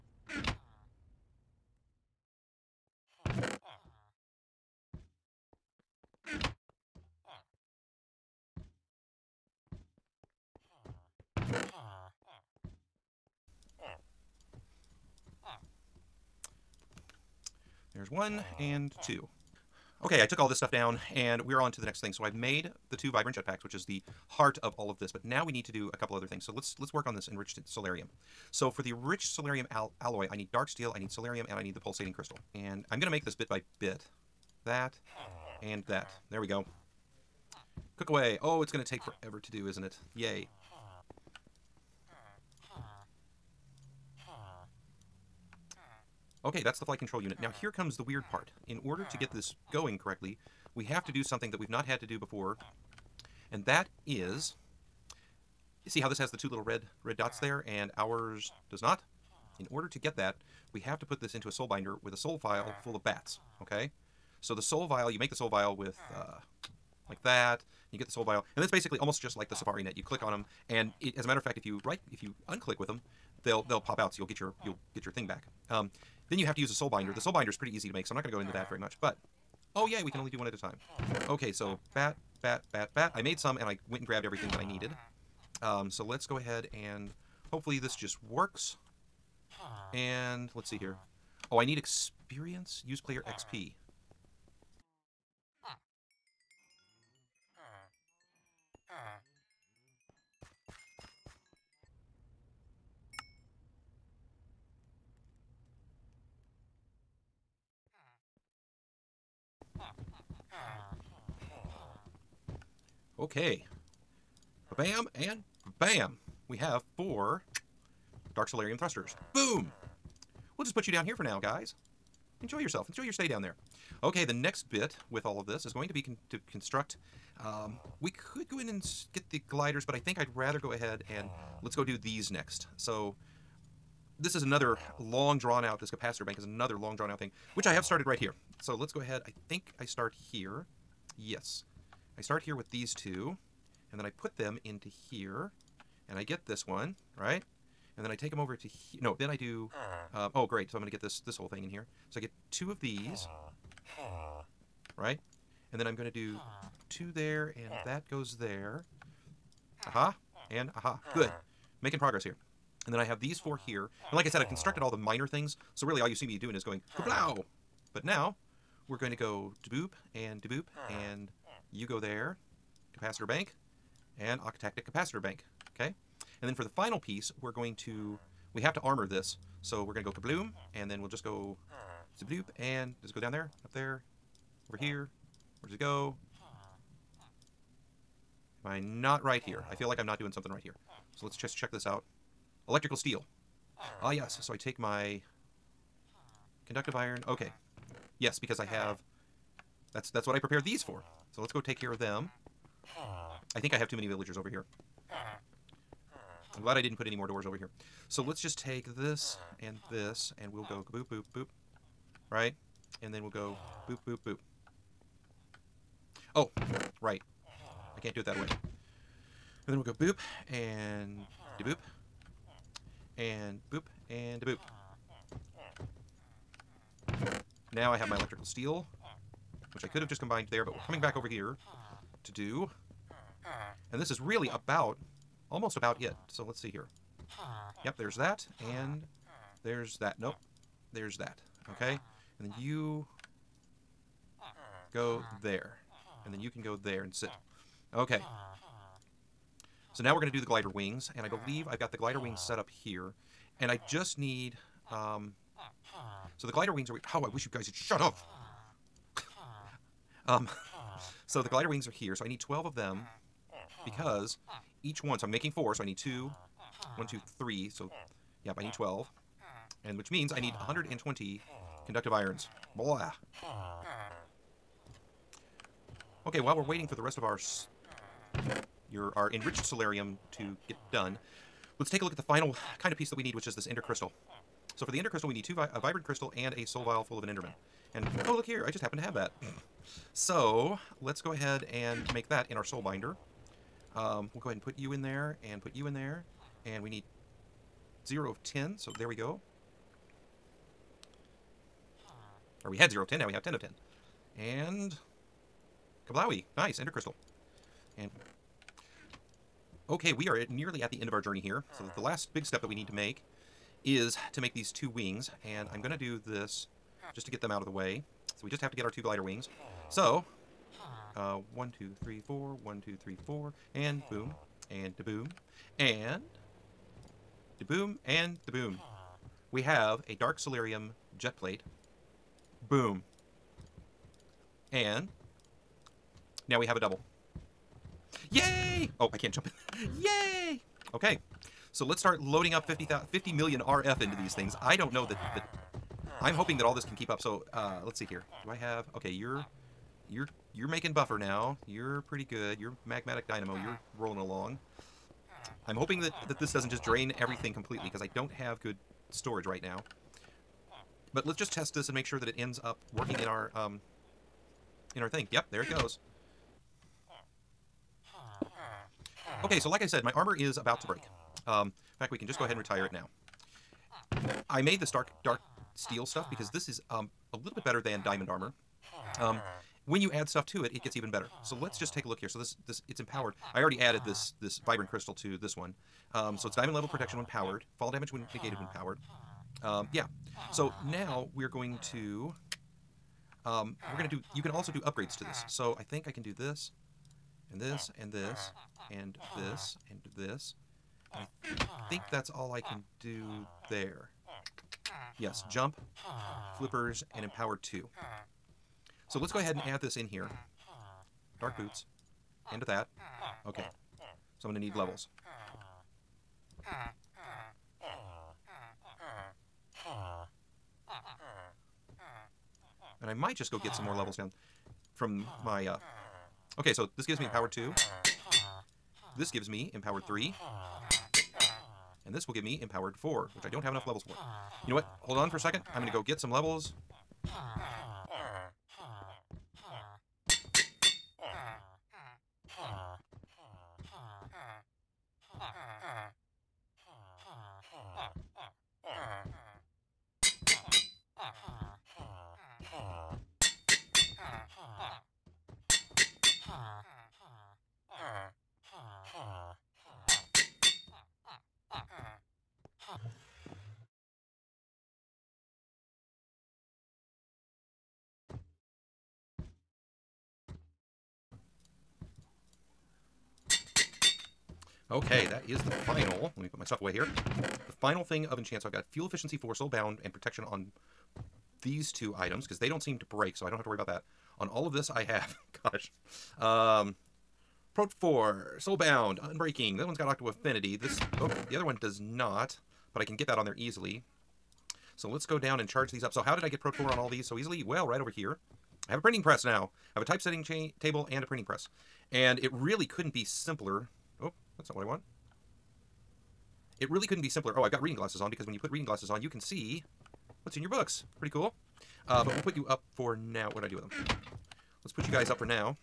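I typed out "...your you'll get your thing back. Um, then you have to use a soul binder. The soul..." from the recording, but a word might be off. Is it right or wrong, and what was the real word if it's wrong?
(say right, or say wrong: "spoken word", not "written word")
right.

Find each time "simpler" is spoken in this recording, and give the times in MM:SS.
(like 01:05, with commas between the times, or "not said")
08:23, 08:27.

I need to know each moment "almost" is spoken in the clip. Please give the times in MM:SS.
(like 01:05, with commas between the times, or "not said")
01:08, 03:55.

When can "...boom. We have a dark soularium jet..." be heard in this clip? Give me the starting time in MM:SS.
05:28.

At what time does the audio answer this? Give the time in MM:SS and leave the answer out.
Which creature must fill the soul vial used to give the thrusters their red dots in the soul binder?
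01:03.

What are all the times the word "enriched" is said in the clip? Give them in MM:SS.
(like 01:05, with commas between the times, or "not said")
00:27, 04:39.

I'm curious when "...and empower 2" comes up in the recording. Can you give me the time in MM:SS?
06:47.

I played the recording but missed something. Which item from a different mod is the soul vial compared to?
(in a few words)
Safari Net.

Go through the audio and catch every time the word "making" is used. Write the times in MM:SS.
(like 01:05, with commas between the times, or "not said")
02:41, 04:25, 05:50.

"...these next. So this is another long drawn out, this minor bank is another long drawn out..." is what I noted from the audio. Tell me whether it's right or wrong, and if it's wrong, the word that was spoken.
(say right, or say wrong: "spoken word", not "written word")
wrong: "capacitor", not "minor".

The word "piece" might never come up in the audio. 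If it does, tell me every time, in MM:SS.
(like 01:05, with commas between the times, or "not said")
02:56, 04:42.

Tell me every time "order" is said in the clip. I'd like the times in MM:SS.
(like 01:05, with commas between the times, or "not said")
00:48, 00:59.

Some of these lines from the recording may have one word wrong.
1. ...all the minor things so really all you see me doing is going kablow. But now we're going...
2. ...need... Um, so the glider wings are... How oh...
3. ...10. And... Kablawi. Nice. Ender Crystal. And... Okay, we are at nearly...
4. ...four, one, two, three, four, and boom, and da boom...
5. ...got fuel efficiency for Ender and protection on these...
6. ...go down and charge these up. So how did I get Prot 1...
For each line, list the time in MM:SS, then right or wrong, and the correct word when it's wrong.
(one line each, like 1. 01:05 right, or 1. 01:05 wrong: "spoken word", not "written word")
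1. 02:44 right
2. 04:14 right
3. 05:03 right
4. 05:22 right
5. 07:58 wrong: "Soulbound", not "Ender"
6. 08:15 wrong: "4", not "1".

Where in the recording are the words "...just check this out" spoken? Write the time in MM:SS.
03:11.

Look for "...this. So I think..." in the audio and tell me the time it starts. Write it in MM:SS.
06:35.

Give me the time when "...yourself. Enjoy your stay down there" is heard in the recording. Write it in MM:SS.
02:02.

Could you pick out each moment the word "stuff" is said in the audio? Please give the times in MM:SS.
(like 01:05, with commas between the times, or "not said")
00:20, 06:16, 06:20, 07:56.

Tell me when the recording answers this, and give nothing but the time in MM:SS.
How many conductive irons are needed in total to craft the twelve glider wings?
04:30.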